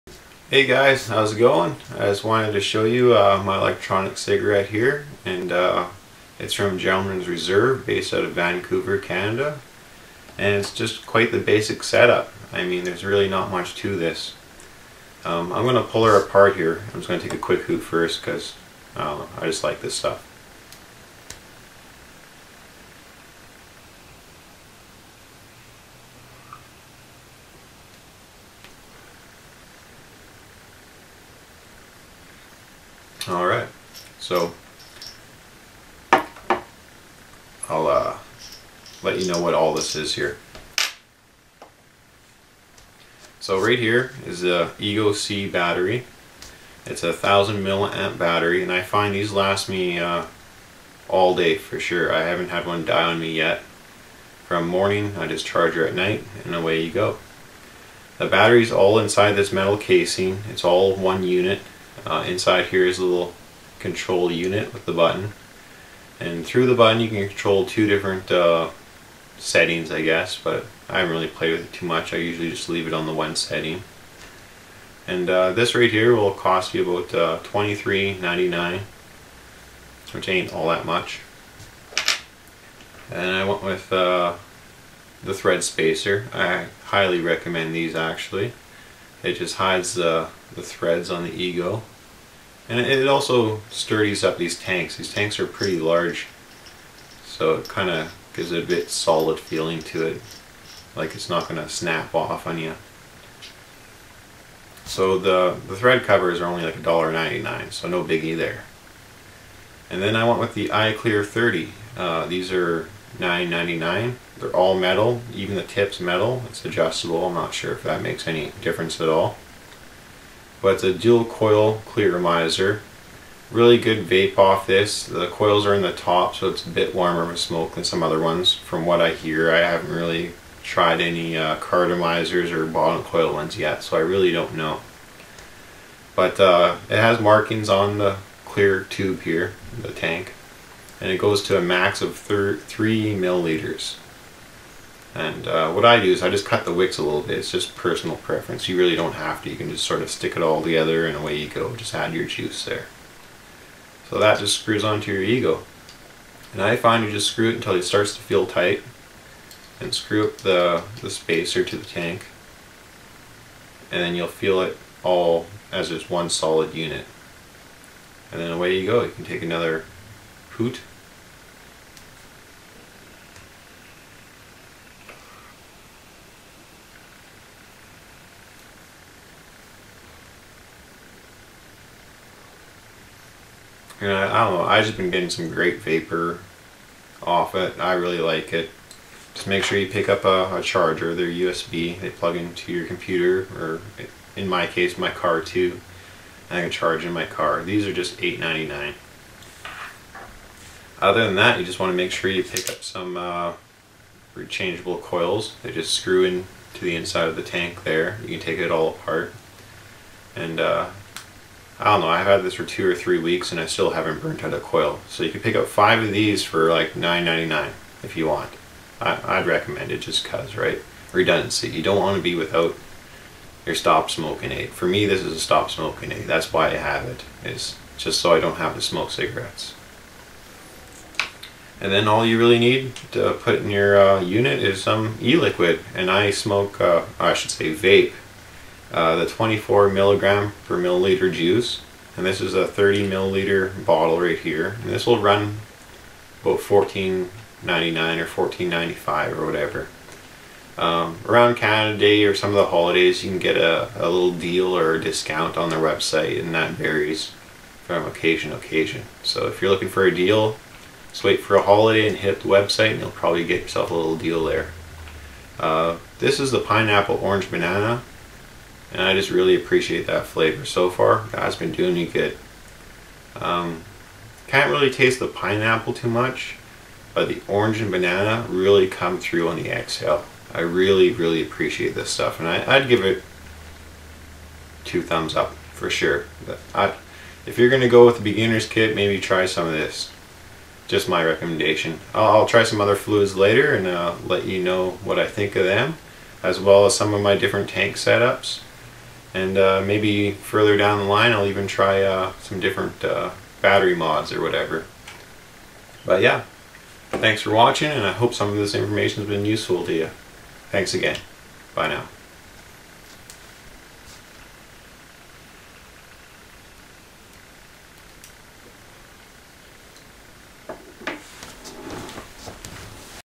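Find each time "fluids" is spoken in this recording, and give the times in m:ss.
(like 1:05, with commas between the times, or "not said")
4:52.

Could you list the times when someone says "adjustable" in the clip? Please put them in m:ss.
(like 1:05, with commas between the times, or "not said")
1:56.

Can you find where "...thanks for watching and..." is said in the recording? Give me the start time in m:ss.
5:07.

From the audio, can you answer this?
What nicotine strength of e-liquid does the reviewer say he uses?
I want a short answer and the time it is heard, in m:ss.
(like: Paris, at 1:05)
24 mg/ml, at 3:59.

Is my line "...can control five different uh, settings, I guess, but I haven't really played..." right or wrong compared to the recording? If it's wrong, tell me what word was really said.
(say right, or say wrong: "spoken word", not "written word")
wrong: "two", not "five".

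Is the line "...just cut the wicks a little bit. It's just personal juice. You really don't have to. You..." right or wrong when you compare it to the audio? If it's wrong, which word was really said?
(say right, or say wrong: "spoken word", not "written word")
wrong: "preference", not "juice".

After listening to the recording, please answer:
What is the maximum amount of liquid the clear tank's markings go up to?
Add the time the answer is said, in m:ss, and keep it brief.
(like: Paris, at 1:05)
3 milliliters, at 2:22.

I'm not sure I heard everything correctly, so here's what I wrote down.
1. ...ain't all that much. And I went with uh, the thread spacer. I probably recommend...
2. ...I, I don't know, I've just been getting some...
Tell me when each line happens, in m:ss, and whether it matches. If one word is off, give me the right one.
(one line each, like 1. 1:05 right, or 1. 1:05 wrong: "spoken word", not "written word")
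1. 1:20 wrong: "highly", not "probably"
2. 3:04 right.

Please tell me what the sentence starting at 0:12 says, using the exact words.
I mean there's really not much to this.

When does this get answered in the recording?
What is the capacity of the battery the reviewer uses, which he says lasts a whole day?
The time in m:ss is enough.
0:47.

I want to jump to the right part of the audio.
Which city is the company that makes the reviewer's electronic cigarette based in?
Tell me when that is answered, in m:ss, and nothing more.
0:08.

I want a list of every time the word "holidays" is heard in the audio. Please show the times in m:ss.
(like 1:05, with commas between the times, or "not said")
4:12, 4:21.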